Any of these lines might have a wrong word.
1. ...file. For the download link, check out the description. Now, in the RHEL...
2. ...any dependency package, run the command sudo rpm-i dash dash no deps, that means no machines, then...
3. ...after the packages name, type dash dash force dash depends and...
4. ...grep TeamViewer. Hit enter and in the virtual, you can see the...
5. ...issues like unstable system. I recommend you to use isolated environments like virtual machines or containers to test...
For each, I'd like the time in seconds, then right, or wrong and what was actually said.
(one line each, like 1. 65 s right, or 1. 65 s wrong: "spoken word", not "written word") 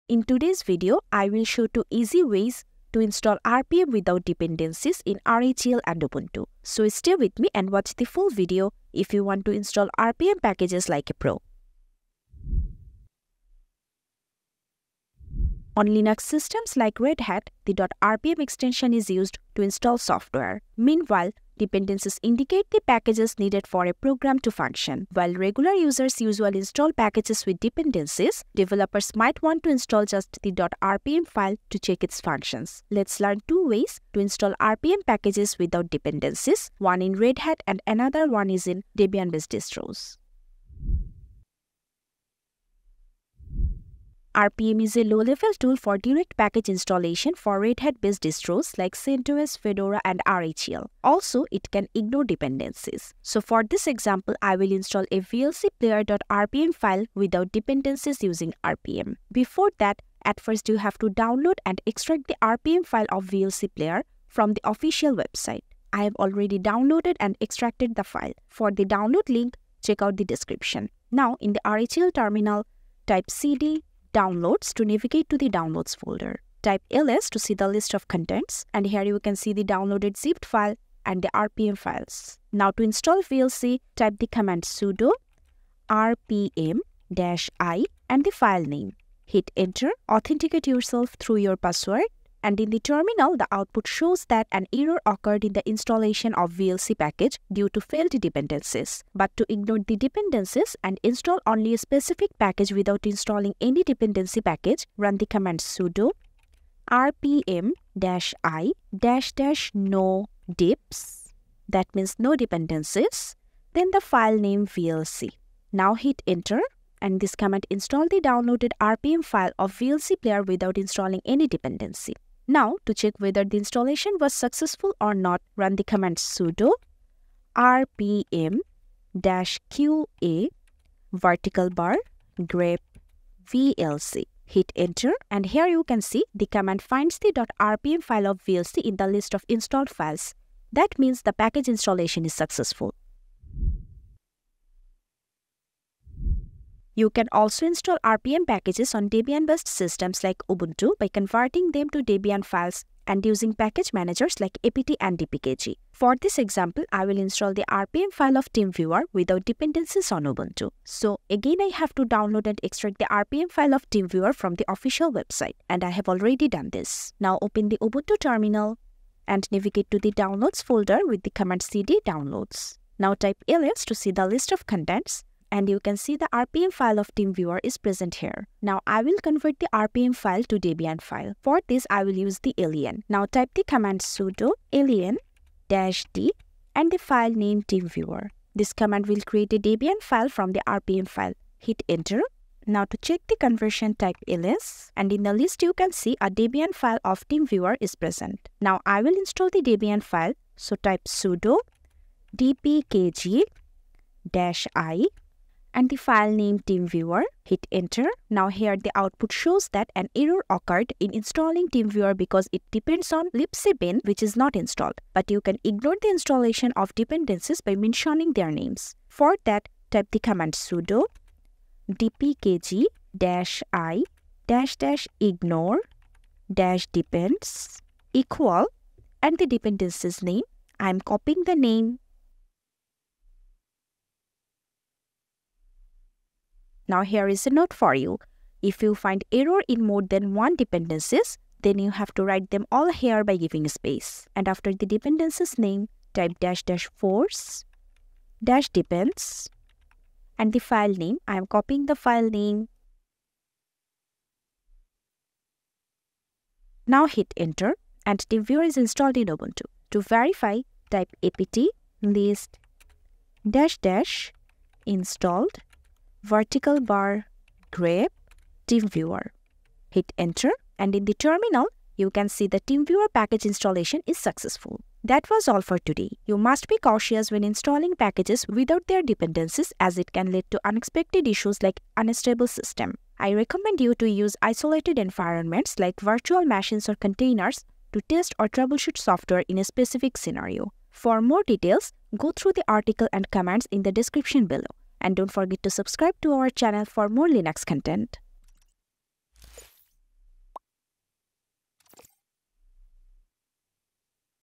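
1. 68 s right
2. 103 s wrong: "dependencies", not "machines"
3. 244 s wrong: "dependencies", not "packages"
4. 267 s wrong: "terminal", not "virtual"
5. 281 s right.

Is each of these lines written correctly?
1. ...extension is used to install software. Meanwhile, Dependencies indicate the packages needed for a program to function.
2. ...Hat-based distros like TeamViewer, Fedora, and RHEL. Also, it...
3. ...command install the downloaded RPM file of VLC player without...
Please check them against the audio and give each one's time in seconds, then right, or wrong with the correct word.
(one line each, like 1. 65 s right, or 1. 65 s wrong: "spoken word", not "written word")
1. 18 s right
2. 47 s wrong: "CentOS", not "TeamViewer"
3. 117 s right.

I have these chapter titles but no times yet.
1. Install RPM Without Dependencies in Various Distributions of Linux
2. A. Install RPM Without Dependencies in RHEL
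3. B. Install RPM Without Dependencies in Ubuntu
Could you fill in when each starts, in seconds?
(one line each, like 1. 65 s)
1. 13 s
2. 42 s
3. 145 s.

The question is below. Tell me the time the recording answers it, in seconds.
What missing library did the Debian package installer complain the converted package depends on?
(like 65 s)
213 s.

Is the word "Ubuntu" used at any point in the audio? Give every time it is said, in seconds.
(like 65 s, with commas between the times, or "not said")
6 s, 150 s, 160 s, 167 s, 259 s.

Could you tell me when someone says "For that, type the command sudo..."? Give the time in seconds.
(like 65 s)
219 s.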